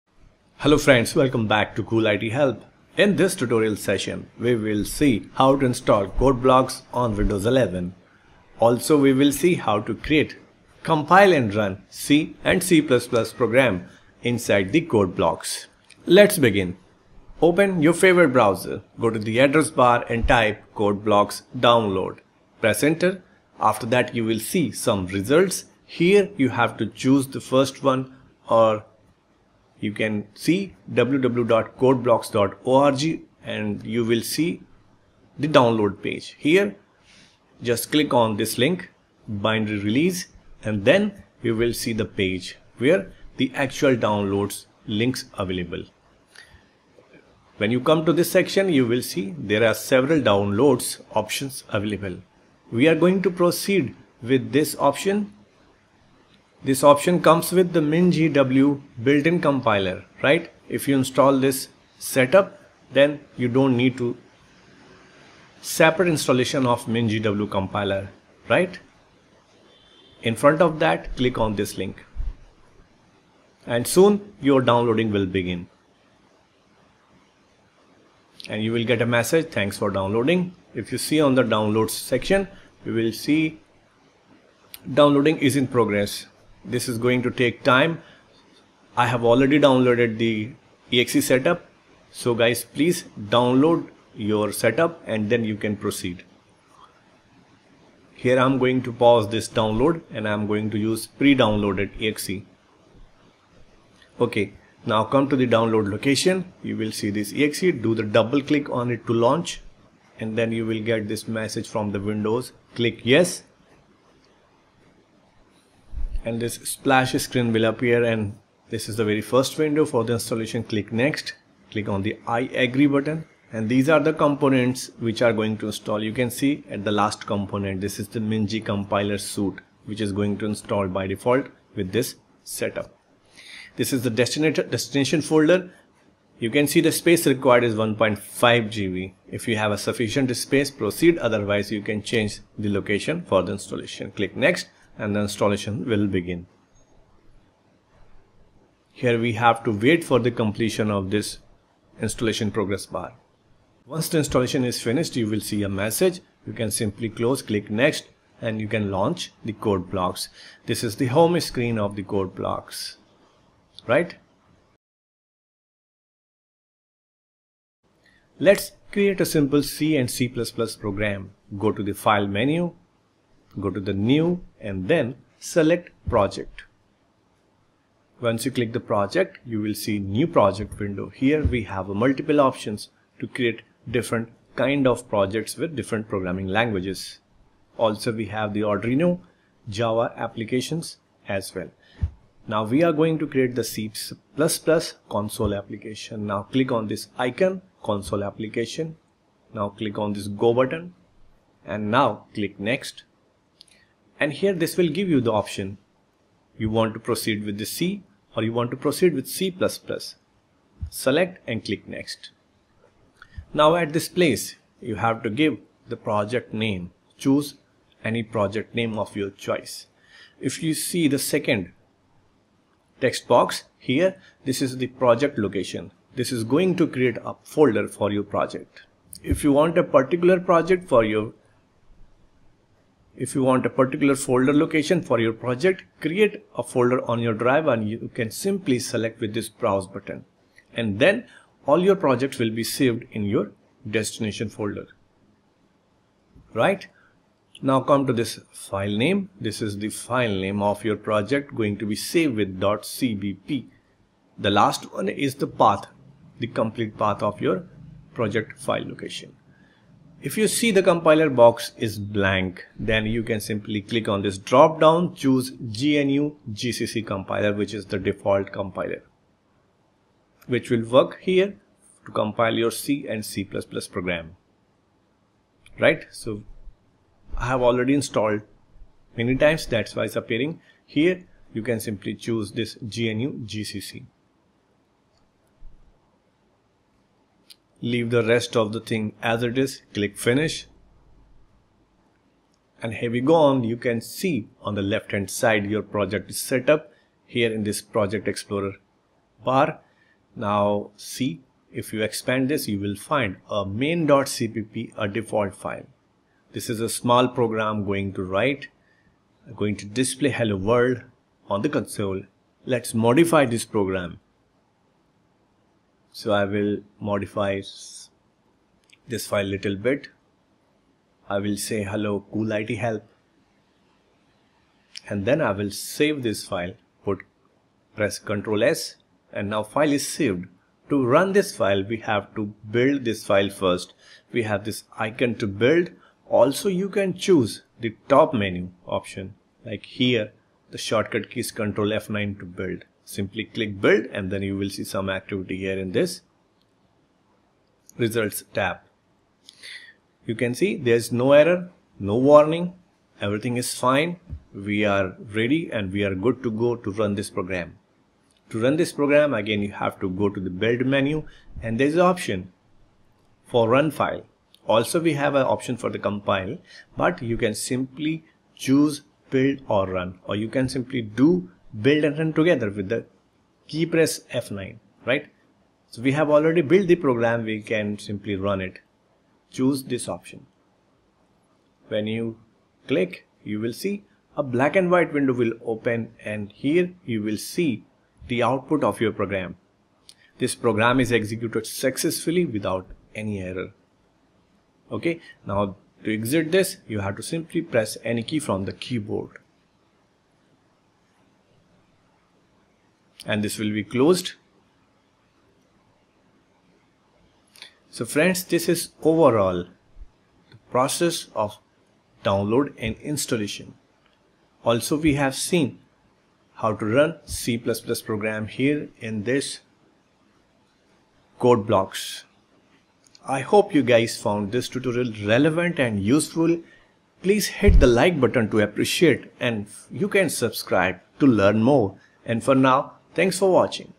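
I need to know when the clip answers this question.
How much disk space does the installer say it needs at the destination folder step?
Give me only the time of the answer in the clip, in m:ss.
2:17.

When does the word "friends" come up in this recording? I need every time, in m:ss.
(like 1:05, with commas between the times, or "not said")
0:00, 6:48.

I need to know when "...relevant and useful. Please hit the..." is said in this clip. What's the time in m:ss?
7:05.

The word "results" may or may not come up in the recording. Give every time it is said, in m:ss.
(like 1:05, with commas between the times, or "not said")
0:25, 5:47.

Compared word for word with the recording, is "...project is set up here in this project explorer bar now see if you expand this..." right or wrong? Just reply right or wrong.
right.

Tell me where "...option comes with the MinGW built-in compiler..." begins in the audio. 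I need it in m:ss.
0:56.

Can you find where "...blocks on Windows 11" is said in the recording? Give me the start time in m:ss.
0:06.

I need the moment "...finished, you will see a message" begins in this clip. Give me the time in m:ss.
2:34.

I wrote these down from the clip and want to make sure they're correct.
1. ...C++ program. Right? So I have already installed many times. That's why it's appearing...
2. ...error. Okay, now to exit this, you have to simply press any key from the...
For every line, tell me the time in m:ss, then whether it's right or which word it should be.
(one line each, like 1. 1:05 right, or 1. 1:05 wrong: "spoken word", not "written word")
1. 4:33 right
2. 6:33 right.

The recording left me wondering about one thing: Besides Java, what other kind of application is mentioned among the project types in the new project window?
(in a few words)
Arduino.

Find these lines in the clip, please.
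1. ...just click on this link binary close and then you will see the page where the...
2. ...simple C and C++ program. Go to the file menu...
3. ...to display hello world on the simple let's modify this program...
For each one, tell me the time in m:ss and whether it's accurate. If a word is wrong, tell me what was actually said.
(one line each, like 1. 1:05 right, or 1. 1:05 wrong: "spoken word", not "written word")
1. 0:37 wrong: "release", not "close"
2. 2:49 right
3. 5:09 wrong: "console", not "simple".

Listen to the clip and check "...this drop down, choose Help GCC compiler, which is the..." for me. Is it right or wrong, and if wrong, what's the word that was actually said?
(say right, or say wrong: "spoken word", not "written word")
wrong: "GNU", not "Help".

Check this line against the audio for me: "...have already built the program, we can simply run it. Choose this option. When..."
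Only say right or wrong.
right.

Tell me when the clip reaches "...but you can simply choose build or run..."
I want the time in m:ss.
6:06.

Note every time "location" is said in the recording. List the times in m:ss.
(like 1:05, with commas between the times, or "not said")
1:45, 2:22, 3:45, 3:54, 4:18.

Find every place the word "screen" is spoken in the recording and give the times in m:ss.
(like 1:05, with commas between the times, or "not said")
1:57, 2:41.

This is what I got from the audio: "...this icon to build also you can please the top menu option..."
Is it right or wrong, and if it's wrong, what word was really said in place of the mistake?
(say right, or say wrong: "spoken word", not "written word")
wrong: "choose", not "please".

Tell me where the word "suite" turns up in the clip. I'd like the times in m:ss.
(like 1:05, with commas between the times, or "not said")
2:09.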